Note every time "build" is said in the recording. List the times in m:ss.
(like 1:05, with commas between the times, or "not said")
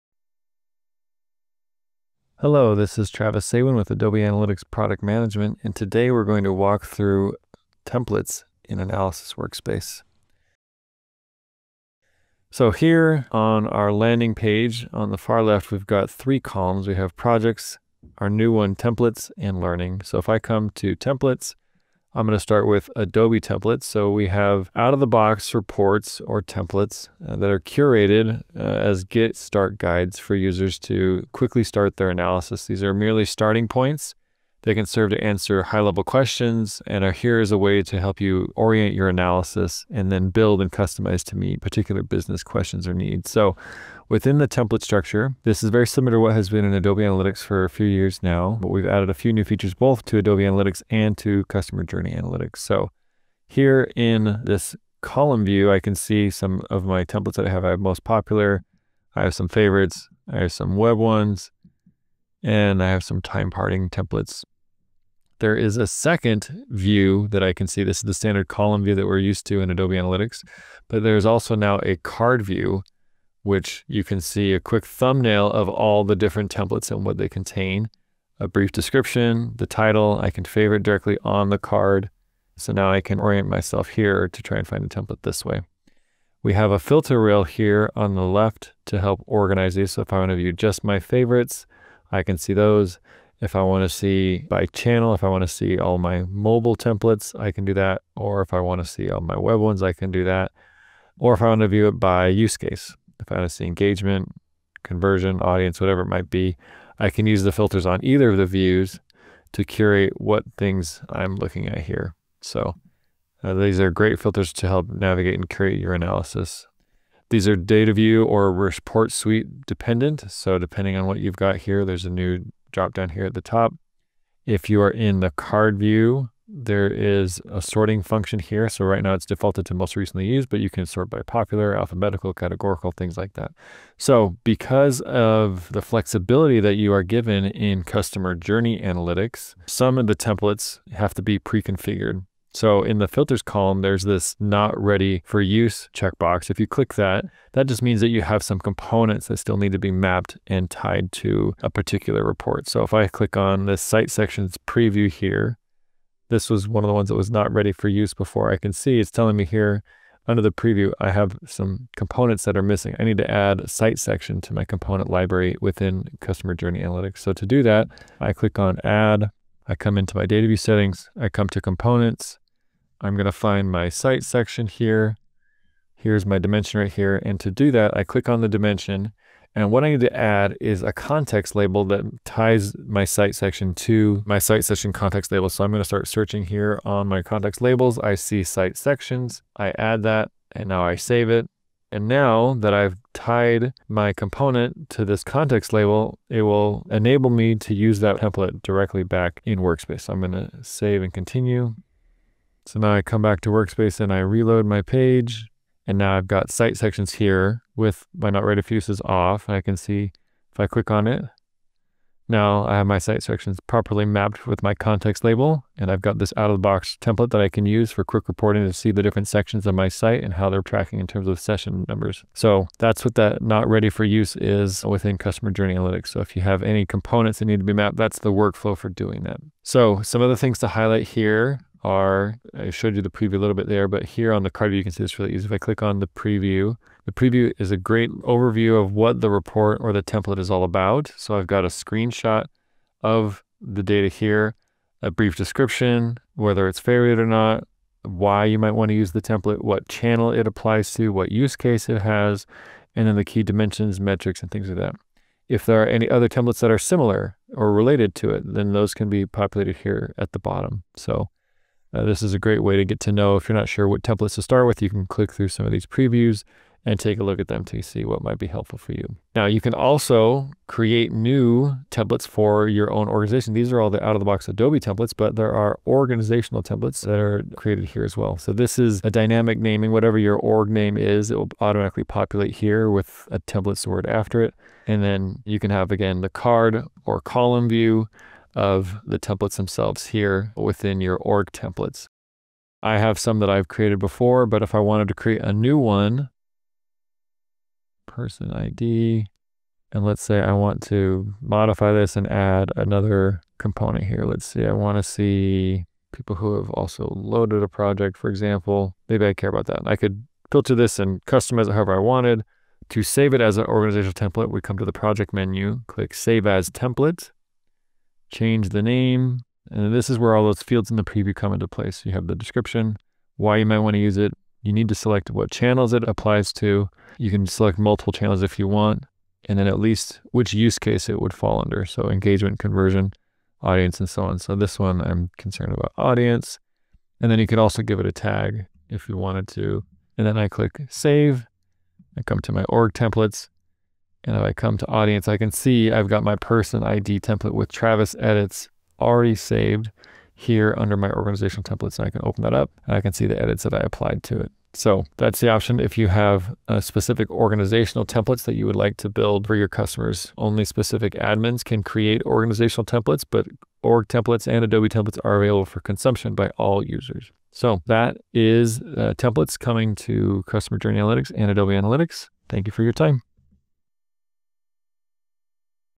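0:40, 5:59.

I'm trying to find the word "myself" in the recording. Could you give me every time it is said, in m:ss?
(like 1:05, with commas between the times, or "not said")
1:23.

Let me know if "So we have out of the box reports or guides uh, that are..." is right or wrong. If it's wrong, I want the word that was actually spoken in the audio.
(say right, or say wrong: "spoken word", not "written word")
wrong: "templates", not "guides".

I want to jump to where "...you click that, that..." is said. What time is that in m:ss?
2:26.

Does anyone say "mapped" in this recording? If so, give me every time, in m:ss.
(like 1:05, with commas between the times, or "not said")
2:29, 3:34, 3:47.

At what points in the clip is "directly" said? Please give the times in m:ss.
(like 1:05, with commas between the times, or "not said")
1:20, 3:18.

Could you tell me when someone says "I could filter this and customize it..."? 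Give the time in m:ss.
5:09.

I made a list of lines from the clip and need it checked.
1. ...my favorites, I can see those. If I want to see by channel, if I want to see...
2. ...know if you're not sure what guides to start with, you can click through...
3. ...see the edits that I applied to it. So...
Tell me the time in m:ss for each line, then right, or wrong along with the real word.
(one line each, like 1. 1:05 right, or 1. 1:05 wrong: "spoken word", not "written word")
1. 1:30 right
2. 4:23 wrong: "templates", not "guides"
3. 5:53 right.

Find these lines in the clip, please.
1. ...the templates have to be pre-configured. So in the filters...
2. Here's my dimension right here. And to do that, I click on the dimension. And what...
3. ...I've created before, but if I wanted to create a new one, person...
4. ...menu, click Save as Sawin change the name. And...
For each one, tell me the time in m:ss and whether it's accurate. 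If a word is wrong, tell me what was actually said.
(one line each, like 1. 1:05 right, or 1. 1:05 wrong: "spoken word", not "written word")
1. 2:20 right
2. 2:55 right
3. 4:53 right
4. 5:15 wrong: "Template", not "Sawin".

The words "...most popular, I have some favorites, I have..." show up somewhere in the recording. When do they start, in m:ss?
0:57.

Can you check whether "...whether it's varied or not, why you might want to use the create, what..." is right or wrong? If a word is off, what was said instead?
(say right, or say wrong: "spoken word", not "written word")
wrong: "template", not "create".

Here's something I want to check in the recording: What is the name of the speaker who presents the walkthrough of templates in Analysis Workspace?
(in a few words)
Travis Sawin.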